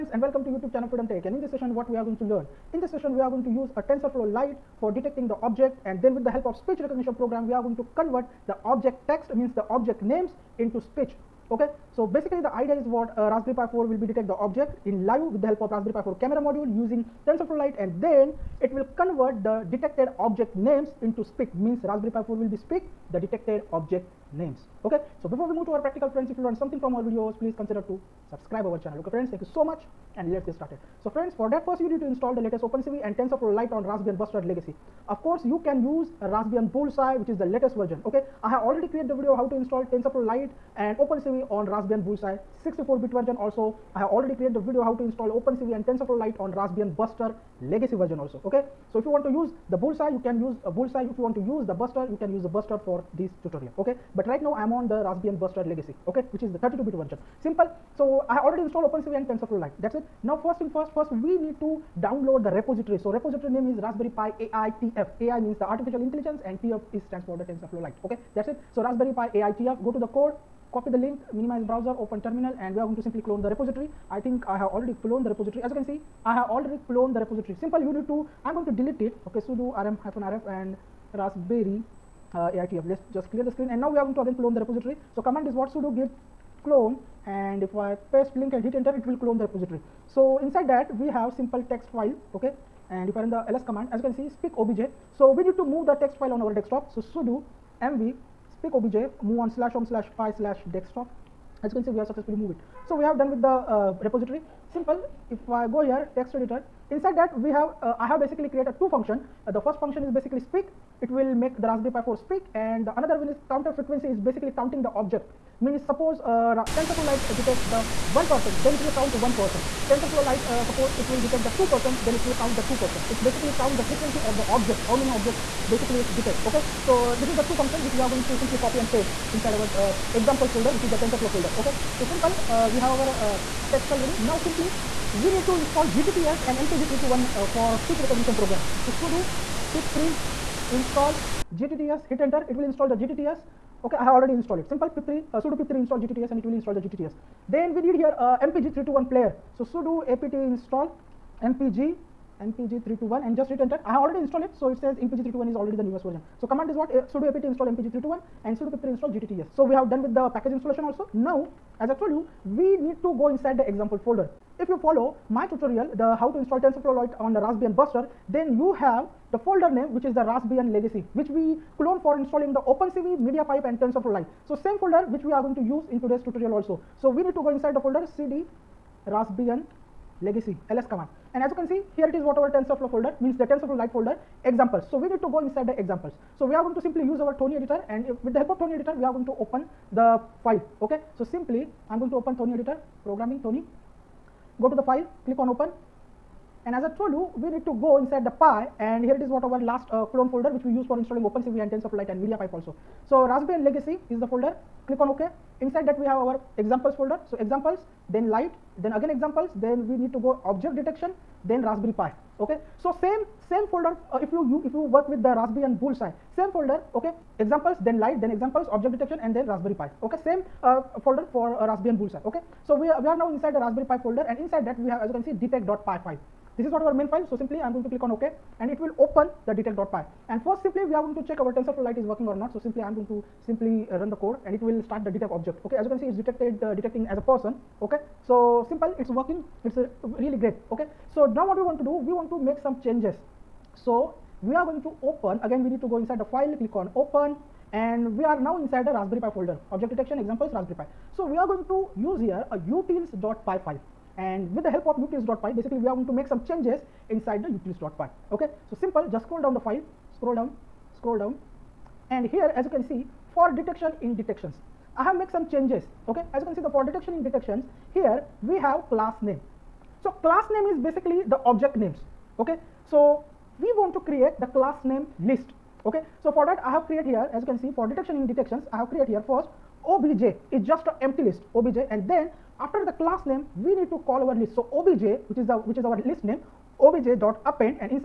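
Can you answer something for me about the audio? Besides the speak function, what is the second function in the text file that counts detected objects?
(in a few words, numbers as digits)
counter frequency.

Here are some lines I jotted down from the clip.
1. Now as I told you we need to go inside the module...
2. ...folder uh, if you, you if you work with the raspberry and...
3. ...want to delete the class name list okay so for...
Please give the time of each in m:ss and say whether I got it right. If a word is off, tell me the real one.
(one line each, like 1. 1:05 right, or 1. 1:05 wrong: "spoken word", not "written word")
1. 2:41 wrong: "example", not "module"
2. 3:33 right
3. 4:33 wrong: "create", not "delete".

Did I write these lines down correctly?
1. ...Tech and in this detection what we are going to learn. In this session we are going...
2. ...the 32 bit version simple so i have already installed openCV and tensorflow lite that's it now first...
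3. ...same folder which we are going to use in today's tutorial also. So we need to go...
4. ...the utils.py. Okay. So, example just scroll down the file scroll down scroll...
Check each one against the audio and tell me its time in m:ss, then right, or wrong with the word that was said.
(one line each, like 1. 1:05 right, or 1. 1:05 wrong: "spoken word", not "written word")
1. 0:01 wrong: "session", not "detection"
2. 0:56 right
3. 2:54 right
4. 4:17 wrong: "simple", not "example".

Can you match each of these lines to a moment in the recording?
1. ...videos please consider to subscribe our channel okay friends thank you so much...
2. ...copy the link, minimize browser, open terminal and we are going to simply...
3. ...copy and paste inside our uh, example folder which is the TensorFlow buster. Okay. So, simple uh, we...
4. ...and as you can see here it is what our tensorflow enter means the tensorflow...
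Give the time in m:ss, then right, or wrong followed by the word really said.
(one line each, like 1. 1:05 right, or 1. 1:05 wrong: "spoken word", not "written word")
1. 0:27 right
2. 1:10 right
3. 2:08 wrong: "folder", not "buster"
4. 3:01 wrong: "folder", not "enter".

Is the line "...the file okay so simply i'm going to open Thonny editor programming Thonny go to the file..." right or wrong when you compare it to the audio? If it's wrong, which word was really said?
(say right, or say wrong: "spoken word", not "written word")
right.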